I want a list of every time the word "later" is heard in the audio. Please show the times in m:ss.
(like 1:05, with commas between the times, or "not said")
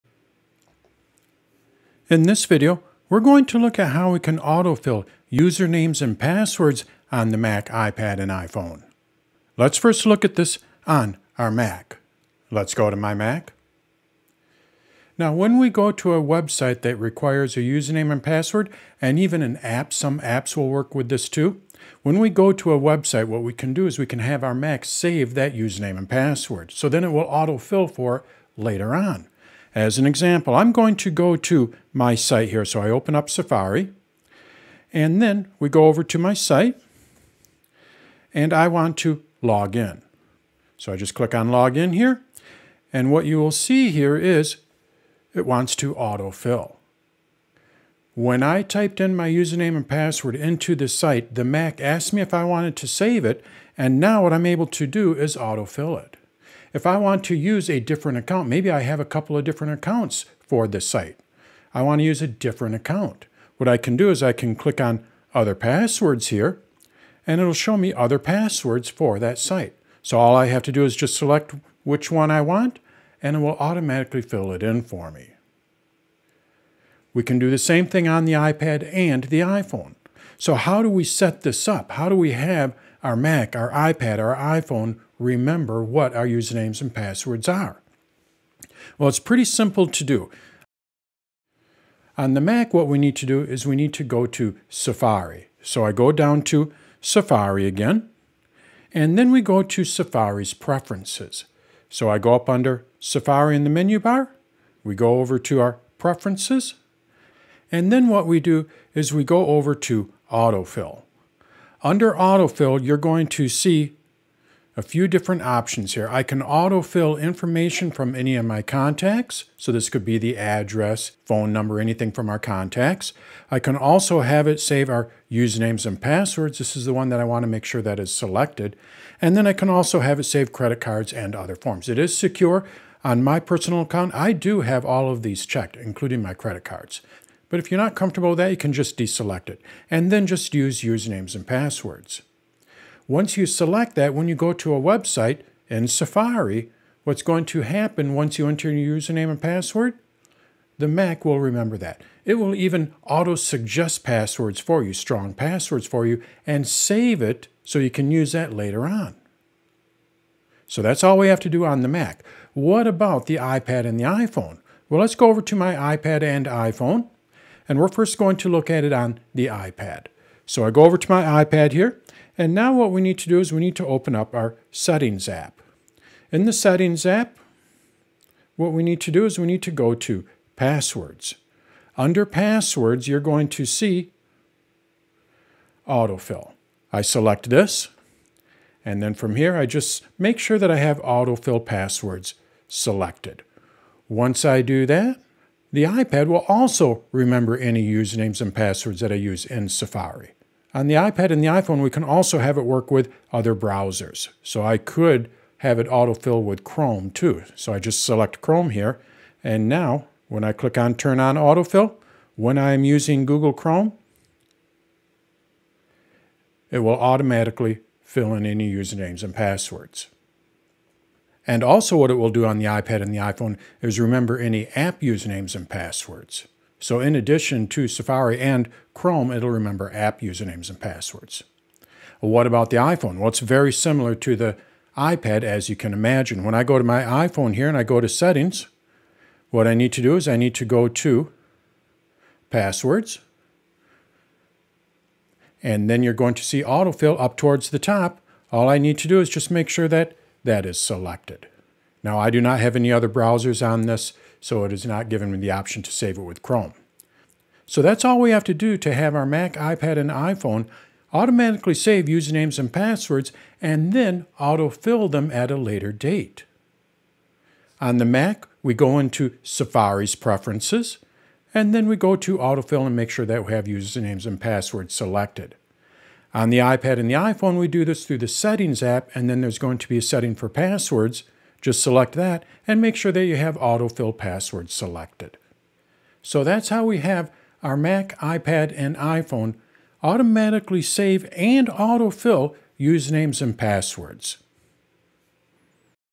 0:28, 2:38, 4:25.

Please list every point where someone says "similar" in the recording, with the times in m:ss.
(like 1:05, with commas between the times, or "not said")
3:53.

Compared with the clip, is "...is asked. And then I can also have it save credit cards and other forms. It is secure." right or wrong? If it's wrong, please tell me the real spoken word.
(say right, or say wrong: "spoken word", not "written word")
wrong: "selected", not "asked".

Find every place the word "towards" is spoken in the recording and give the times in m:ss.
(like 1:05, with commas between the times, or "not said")
4:07.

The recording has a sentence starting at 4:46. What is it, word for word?
So that's how we have our Mac, iPad, and iPhone automatically save and autofill usernames and passwords.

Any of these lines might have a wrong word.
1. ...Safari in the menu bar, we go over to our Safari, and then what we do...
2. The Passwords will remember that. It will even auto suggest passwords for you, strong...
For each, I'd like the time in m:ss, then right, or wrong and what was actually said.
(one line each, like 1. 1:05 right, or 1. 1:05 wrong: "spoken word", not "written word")
1. 1:42 wrong: "Preferences", not "Safari"
2. 2:30 wrong: "Mac", not "Passwords".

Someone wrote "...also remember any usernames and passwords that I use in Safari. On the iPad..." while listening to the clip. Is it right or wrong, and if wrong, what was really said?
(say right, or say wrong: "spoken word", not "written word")
right.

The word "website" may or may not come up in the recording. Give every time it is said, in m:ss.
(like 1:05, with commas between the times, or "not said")
0:16, 0:22, 2:24.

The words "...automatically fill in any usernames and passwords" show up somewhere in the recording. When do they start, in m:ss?
3:36.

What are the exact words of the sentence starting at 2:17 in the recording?
But if you're not comfortable with that, you can just deselect it and then just use usernames and passwords.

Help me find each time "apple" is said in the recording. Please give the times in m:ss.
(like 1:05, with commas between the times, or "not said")
not said.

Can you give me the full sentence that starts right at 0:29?
As an example, I'm going to go to my site here.